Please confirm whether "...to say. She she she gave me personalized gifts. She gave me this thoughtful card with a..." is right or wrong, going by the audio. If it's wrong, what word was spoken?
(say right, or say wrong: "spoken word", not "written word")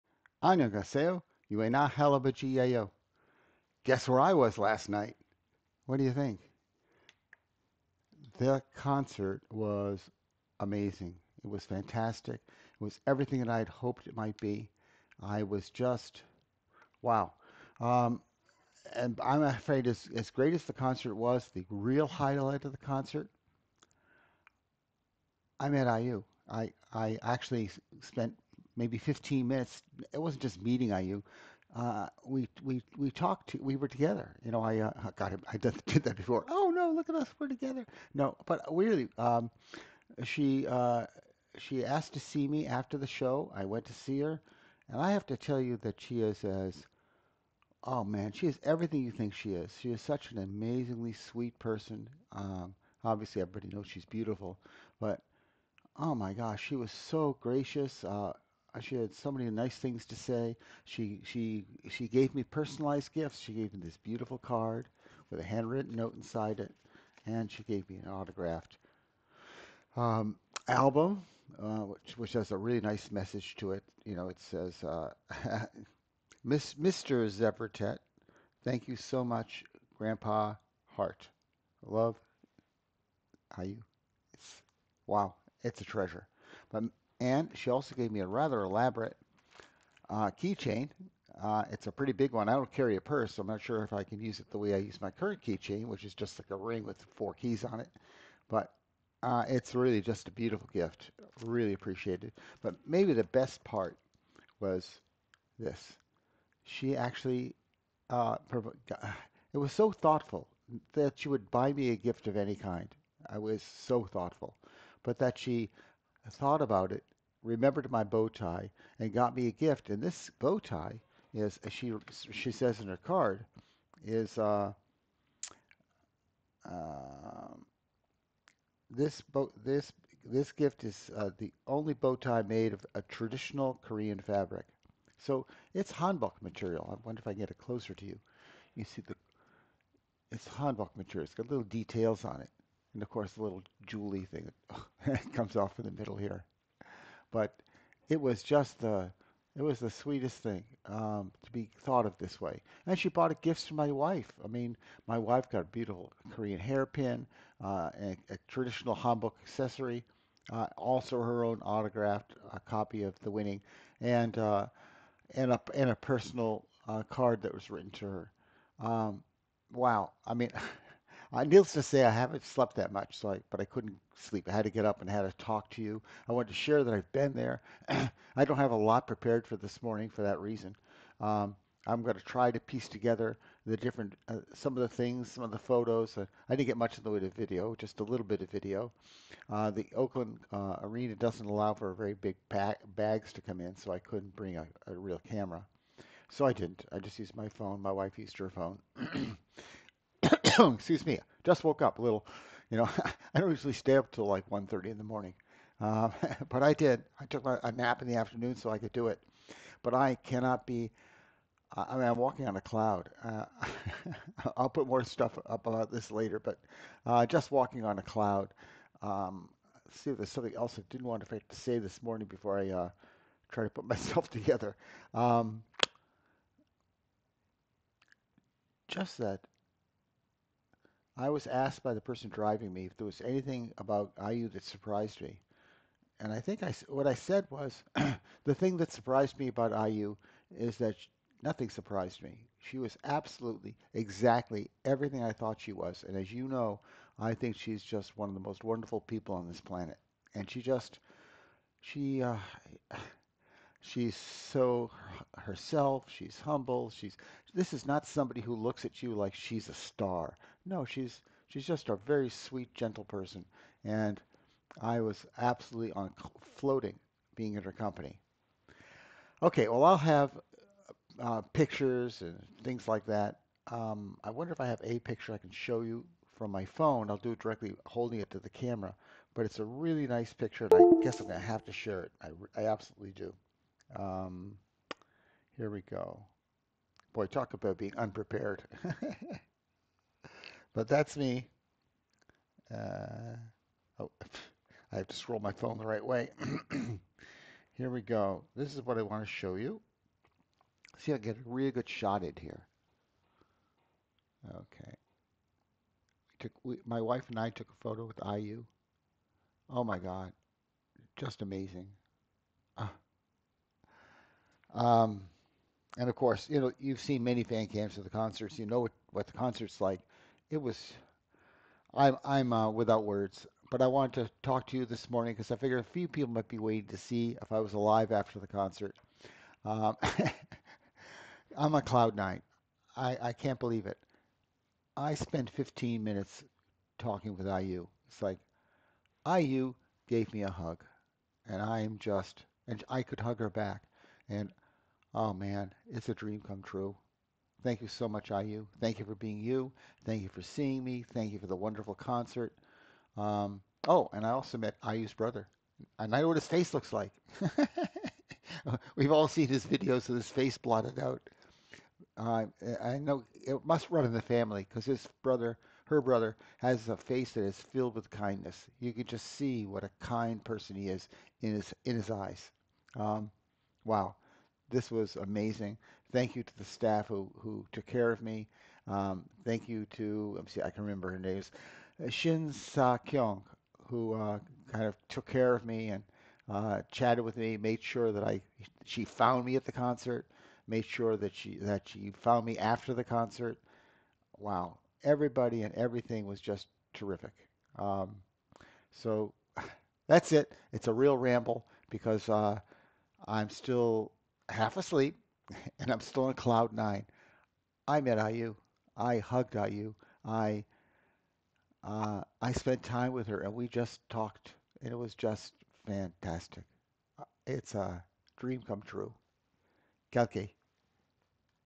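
wrong: "beautiful", not "thoughtful".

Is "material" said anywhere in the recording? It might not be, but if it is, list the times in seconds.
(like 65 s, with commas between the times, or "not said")
136 s, 140 s.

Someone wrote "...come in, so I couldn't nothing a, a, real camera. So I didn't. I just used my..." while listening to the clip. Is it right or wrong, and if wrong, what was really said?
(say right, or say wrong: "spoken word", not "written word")
wrong: "bring", not "nothing".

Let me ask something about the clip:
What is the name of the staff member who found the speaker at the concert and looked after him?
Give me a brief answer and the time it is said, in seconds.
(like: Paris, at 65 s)
Shin Sa Kyung, at 382 s.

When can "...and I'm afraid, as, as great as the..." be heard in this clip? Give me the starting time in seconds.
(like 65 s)
18 s.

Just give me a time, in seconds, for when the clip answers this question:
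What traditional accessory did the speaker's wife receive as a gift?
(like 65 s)
156 s.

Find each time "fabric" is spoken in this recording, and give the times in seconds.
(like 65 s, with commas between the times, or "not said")
134 s.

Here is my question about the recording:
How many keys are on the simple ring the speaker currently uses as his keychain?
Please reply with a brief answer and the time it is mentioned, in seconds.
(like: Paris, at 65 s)
4, at 97 s.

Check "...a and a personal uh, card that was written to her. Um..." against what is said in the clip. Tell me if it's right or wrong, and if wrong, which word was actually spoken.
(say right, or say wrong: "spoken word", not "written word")
right.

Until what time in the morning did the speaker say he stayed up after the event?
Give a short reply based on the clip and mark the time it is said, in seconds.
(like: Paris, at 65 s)
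1:30, at 204 s.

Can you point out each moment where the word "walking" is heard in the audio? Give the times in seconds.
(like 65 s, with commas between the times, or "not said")
212 s, 217 s.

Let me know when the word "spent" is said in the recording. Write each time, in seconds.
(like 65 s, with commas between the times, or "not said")
28 s, 335 s, 412 s.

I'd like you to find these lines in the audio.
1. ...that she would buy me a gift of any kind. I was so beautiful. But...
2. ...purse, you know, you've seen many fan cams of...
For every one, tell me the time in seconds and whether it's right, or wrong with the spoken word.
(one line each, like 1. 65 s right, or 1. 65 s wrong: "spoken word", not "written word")
1. 110 s wrong: "thoughtful", not "beautiful"
2. 316 s wrong: "course", not "purse".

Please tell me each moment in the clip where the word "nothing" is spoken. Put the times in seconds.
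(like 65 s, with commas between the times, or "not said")
241 s.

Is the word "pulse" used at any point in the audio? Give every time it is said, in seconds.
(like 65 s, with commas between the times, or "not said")
not said.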